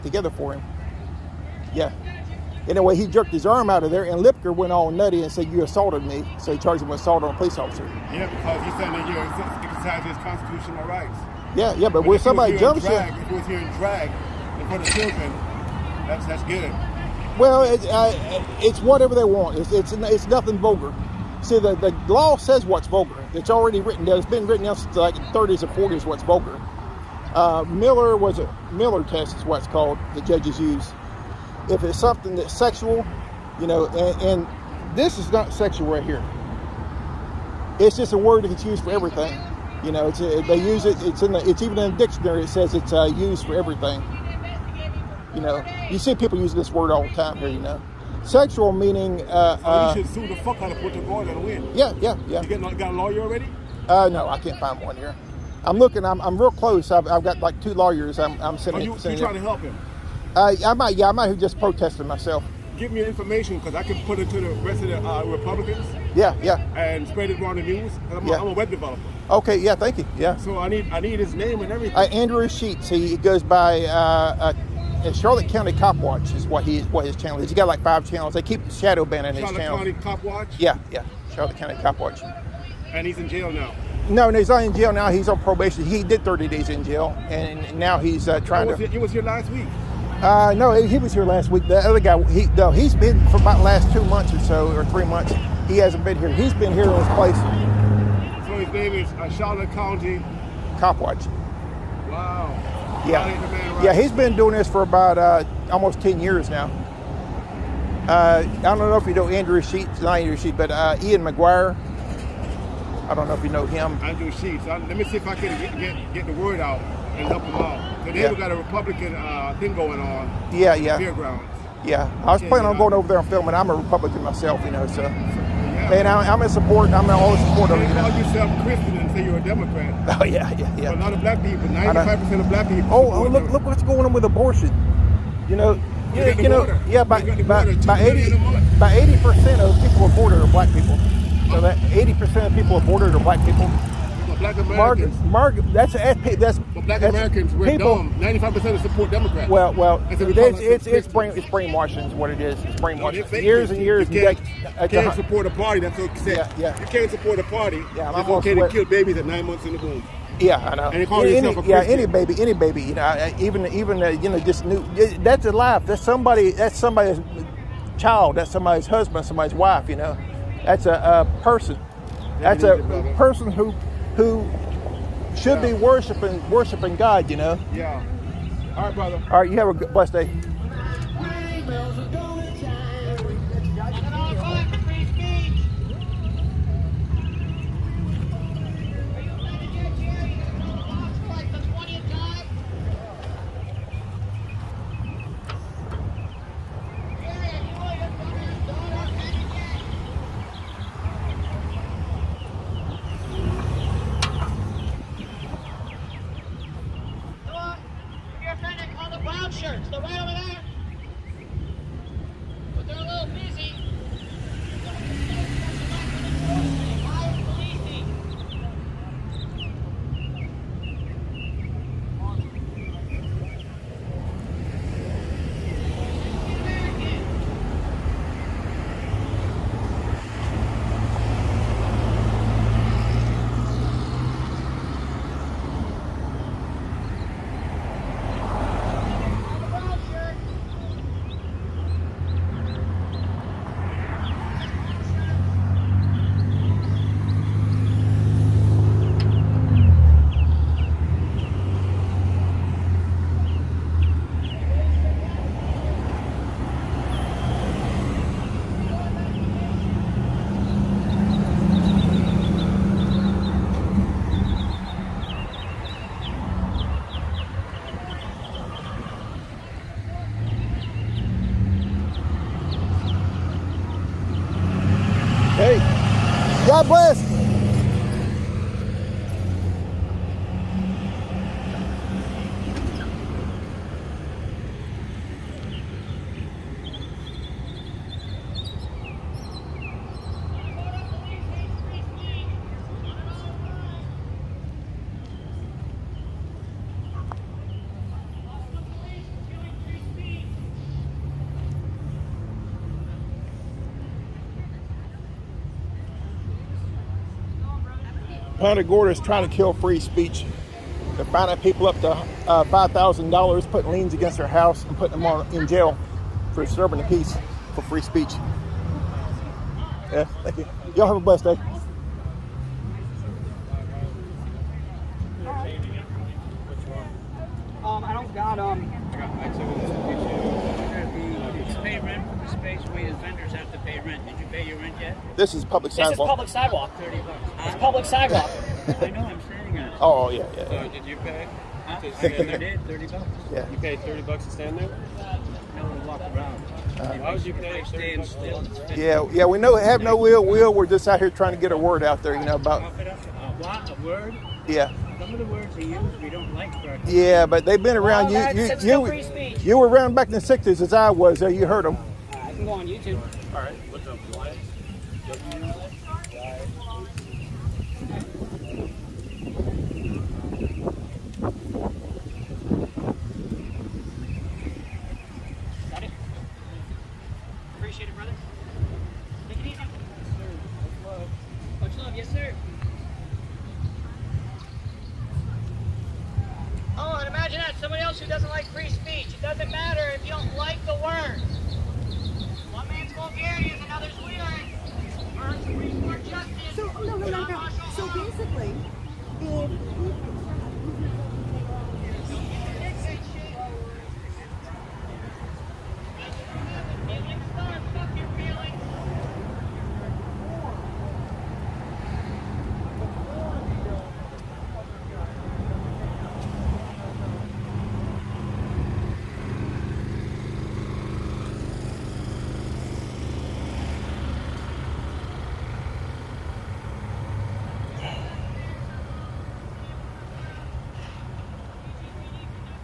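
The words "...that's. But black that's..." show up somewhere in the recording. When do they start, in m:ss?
2:25.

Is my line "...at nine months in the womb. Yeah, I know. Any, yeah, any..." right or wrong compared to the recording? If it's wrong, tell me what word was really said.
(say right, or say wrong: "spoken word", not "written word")
right.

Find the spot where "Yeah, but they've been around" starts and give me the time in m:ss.
5:57.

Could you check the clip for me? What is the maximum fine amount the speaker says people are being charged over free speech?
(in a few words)
$5,000.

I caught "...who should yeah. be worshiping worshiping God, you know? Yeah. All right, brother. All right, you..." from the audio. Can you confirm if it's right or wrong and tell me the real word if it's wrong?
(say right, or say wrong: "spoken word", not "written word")
right.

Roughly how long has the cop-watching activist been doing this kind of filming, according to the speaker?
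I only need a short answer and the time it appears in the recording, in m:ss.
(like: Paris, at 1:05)
almost 10 years, at 1:45.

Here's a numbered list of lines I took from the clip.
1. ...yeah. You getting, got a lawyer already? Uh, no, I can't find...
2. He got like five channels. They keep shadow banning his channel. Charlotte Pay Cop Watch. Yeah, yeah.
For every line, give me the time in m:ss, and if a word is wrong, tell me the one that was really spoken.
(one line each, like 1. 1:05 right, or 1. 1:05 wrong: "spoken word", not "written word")
1. 0:52 right
2. 1:17 wrong: "County", not "Pay".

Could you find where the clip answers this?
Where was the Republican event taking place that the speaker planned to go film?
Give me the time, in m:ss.
2:00.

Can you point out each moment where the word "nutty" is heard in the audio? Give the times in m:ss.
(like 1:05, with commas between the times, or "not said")
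0:04.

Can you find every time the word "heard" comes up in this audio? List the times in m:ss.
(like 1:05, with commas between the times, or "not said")
6:01.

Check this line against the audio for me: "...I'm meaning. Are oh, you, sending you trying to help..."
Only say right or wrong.
wrong.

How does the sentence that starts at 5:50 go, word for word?
We're just out here trying to get a word out there, you know, about.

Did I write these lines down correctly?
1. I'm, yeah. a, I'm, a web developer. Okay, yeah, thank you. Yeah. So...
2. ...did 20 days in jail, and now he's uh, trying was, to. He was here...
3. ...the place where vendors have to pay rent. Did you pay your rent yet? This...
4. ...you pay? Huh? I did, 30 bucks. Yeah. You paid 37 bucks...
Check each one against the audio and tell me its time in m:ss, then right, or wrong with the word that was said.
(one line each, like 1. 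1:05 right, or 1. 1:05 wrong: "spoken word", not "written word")
1. 1:08 right
2. 1:26 wrong: "30", not "20"
3. 5:32 wrong: "space", not "place"
4. 5:41 wrong: "30", not "37".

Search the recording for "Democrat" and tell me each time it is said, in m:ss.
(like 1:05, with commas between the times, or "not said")
2:09, 2:29.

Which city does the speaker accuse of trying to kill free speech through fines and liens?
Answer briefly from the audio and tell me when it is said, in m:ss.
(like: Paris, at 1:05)
Punta Gorda, at 5:08.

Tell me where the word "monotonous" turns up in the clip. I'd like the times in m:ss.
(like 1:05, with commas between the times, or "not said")
not said.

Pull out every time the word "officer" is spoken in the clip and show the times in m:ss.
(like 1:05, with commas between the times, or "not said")
0:07.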